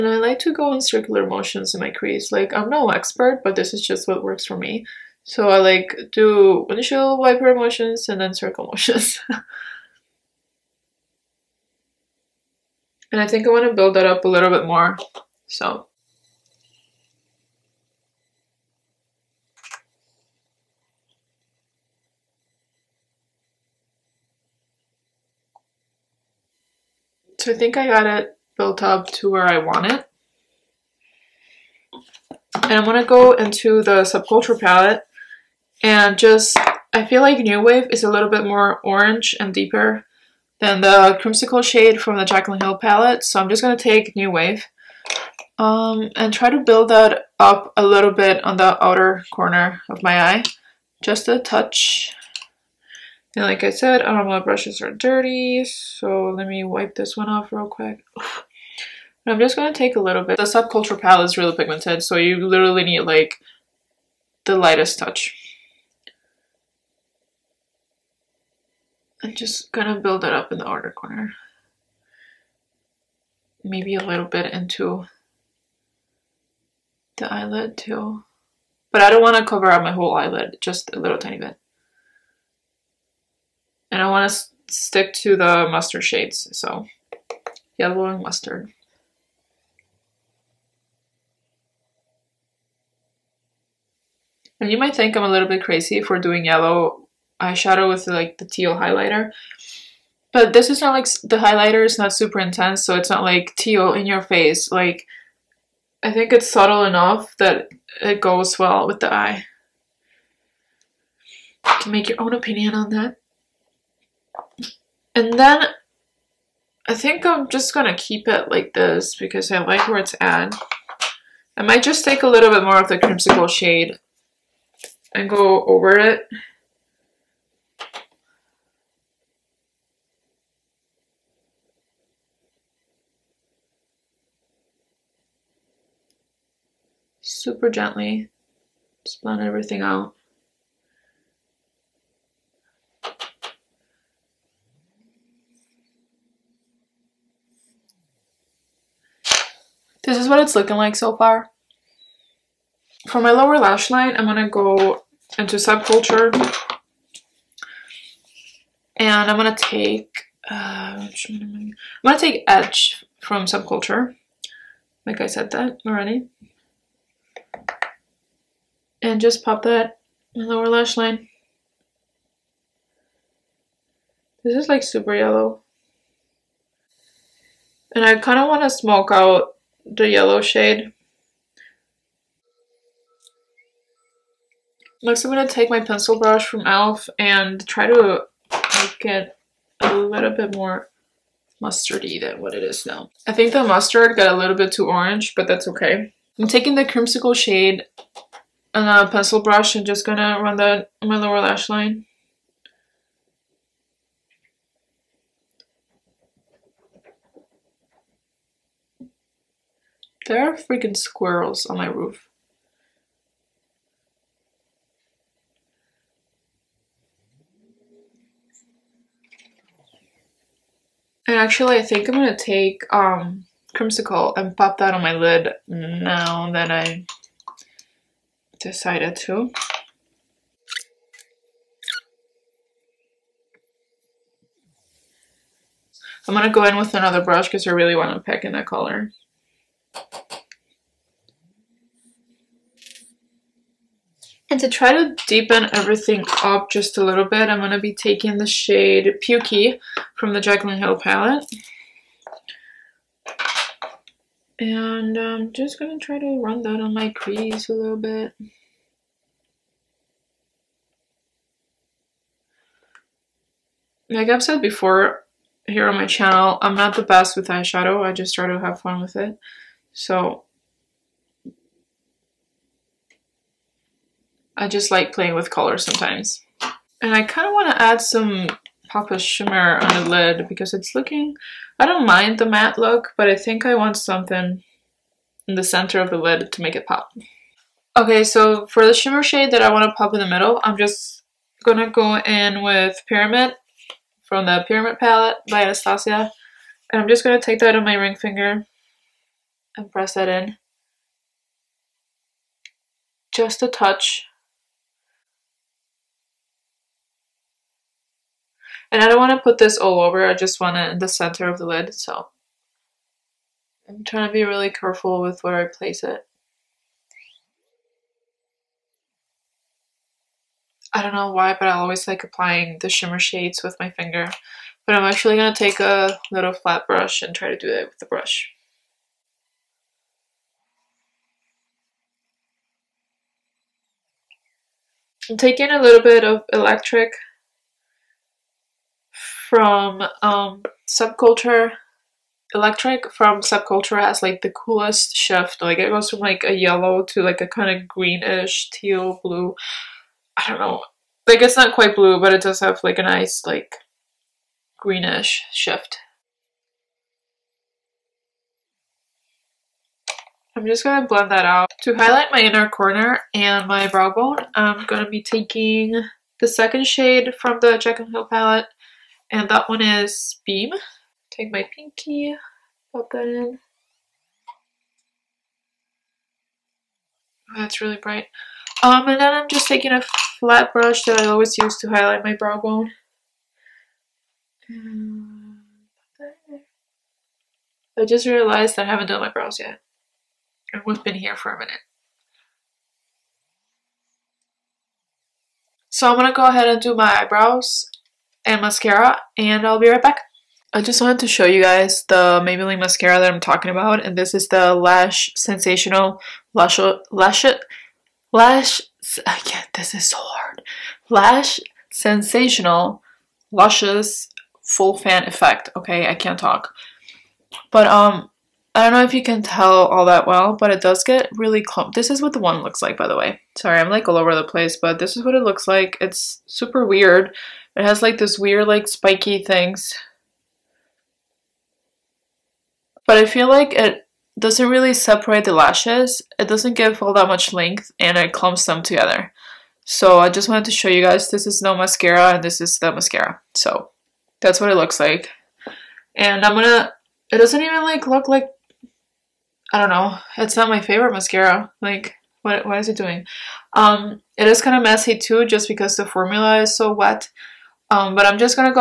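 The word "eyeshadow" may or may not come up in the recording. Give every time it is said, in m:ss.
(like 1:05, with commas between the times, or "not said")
1:37, 4:27.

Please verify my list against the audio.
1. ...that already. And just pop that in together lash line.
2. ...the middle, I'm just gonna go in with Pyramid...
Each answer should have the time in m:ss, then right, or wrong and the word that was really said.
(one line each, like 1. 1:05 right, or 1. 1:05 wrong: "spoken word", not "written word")
1. 2:45 wrong: "lower", not "together"
2. 4:50 right.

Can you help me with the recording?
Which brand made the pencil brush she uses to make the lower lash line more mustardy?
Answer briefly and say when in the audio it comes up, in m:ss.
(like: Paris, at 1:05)
e.l.f., at 3:06.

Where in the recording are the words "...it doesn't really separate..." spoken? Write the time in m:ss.
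7:13.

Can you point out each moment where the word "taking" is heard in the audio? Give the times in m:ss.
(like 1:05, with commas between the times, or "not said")
3:16, 4:07, 5:35, 6:05, 6:19.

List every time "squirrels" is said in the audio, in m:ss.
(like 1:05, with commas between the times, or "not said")
3:30.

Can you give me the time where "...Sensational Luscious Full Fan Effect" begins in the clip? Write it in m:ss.
6:51.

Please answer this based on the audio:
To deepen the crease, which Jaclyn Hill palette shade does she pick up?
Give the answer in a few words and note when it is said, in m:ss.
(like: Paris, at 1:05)
Pukey, at 4:09.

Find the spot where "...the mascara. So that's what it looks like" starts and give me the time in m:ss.
7:22.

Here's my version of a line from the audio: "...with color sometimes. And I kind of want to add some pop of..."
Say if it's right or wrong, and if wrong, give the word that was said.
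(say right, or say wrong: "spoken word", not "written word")
right.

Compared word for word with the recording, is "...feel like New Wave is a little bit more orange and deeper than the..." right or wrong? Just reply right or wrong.
right.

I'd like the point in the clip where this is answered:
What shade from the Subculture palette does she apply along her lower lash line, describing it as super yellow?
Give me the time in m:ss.
2:42.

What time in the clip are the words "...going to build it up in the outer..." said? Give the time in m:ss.
1:09.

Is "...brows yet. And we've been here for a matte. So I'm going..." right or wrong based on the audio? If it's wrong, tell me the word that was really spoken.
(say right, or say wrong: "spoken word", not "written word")
wrong: "minute", not "matte".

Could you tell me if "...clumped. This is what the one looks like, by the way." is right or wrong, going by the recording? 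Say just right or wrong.
right.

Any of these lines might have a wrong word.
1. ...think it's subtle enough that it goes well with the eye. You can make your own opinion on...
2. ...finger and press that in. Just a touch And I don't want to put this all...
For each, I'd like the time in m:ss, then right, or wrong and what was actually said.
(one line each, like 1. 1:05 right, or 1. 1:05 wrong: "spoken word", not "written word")
1. 1:46 right
2. 4:58 right.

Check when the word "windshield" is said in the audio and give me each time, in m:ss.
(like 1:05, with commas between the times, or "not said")
0:06.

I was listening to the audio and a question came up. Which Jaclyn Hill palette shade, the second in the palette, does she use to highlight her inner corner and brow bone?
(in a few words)
Beam.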